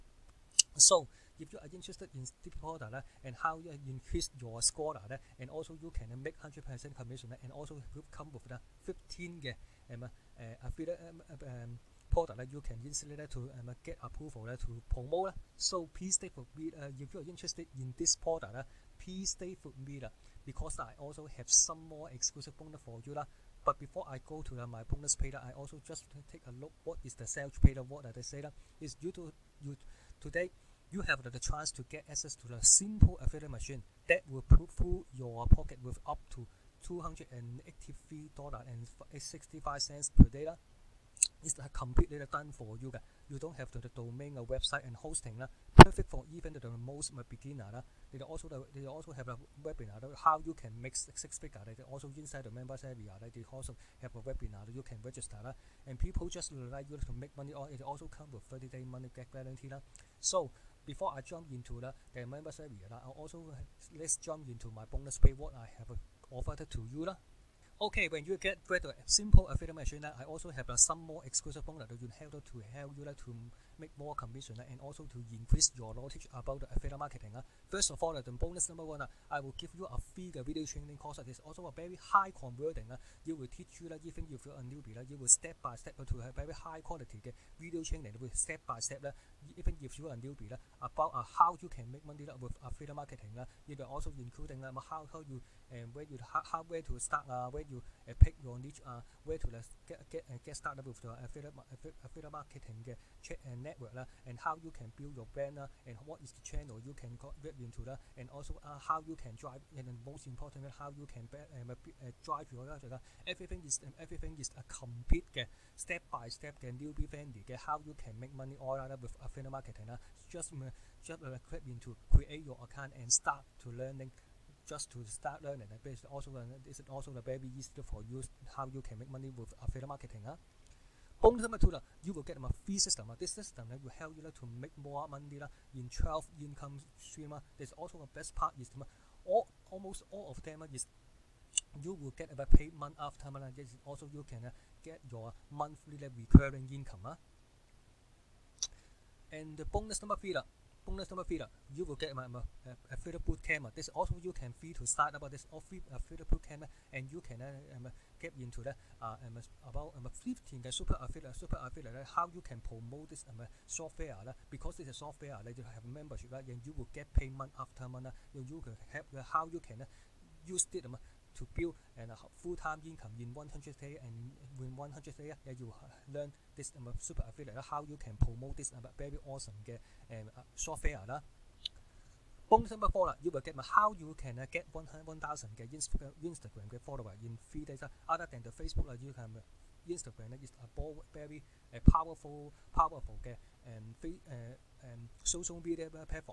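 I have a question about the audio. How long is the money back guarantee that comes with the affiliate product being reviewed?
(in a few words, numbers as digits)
30 days.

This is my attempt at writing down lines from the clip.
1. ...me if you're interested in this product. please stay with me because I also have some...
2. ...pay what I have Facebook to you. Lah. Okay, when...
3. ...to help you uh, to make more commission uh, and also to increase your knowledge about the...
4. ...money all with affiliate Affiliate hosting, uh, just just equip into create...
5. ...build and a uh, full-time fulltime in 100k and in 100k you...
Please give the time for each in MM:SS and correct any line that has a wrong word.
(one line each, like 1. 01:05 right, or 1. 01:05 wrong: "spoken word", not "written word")
1. 00:16 right
2. 01:05 wrong: "Offered", not "Facebook"
3. 01:12 right
4. 01:58 wrong: "marketing", not "hosting"
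5. 02:51 wrong: "income", not "fulltime".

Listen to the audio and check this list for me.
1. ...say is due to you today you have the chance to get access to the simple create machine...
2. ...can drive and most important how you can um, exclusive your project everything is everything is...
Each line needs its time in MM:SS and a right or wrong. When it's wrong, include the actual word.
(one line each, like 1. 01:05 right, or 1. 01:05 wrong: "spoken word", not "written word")
1. 00:28 wrong: "affiliate", not "create"
2. 01:49 wrong: "drive", not "exclusive".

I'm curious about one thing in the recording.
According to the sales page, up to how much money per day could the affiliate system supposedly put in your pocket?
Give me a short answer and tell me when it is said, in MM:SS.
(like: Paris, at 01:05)
$283.65, at 00:36.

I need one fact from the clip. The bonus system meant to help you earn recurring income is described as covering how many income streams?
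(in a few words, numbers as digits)
12.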